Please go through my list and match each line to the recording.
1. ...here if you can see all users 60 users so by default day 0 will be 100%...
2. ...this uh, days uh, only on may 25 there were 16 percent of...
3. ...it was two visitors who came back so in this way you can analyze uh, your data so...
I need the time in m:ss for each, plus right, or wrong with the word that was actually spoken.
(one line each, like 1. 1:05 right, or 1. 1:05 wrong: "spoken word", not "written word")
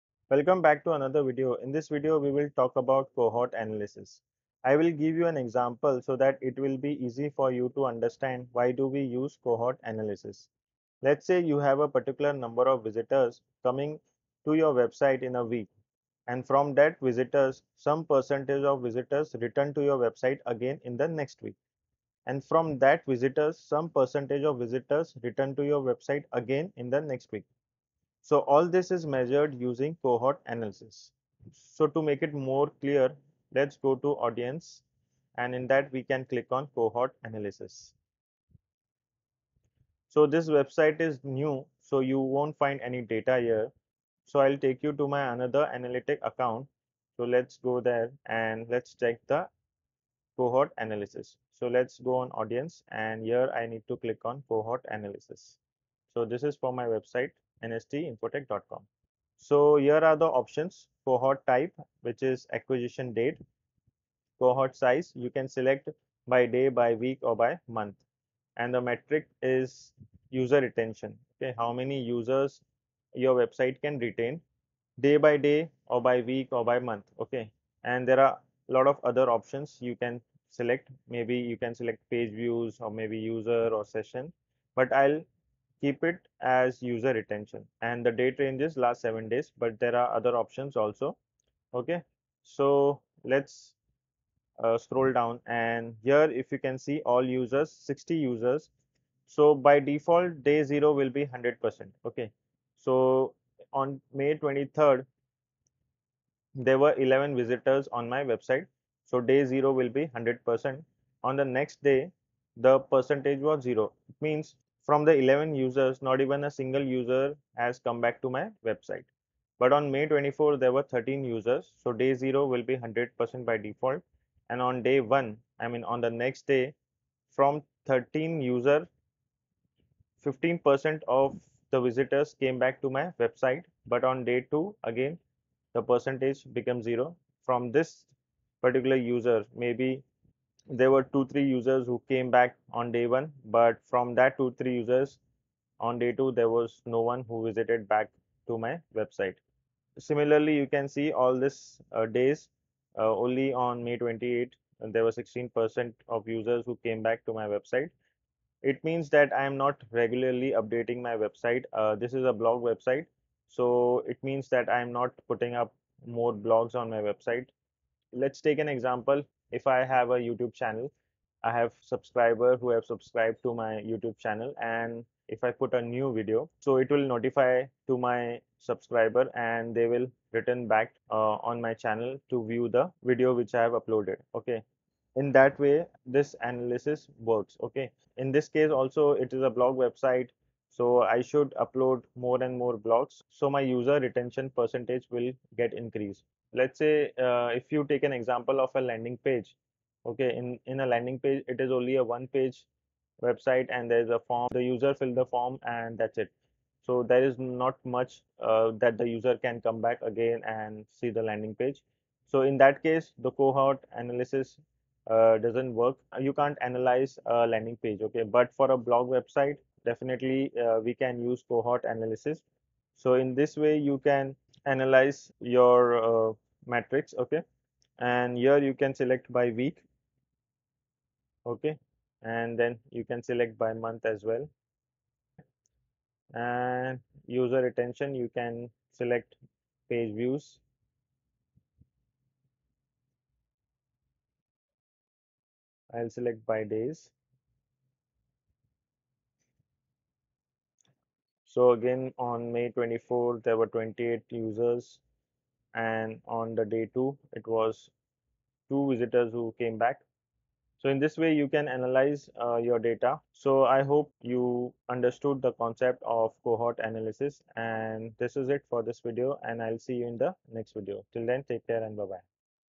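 1. 1:36 right
2. 2:31 wrong: "28", not "25"
3. 4:17 right.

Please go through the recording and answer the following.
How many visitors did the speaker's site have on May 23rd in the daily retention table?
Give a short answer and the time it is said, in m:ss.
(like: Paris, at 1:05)
11, at 1:46.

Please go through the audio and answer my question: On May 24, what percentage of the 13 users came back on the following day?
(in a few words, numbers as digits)
15%.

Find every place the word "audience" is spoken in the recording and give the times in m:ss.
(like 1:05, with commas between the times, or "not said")
0:34, 0:52.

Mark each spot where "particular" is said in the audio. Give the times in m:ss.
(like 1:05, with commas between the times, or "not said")
0:11, 2:18.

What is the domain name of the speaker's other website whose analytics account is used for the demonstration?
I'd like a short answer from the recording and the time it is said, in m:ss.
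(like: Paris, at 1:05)
nstinfotech.com, at 0:57.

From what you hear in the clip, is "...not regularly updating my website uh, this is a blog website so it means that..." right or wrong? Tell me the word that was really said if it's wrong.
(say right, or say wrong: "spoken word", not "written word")
right.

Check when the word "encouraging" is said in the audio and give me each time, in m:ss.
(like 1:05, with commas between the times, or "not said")
not said.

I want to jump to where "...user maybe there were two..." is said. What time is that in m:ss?
2:18.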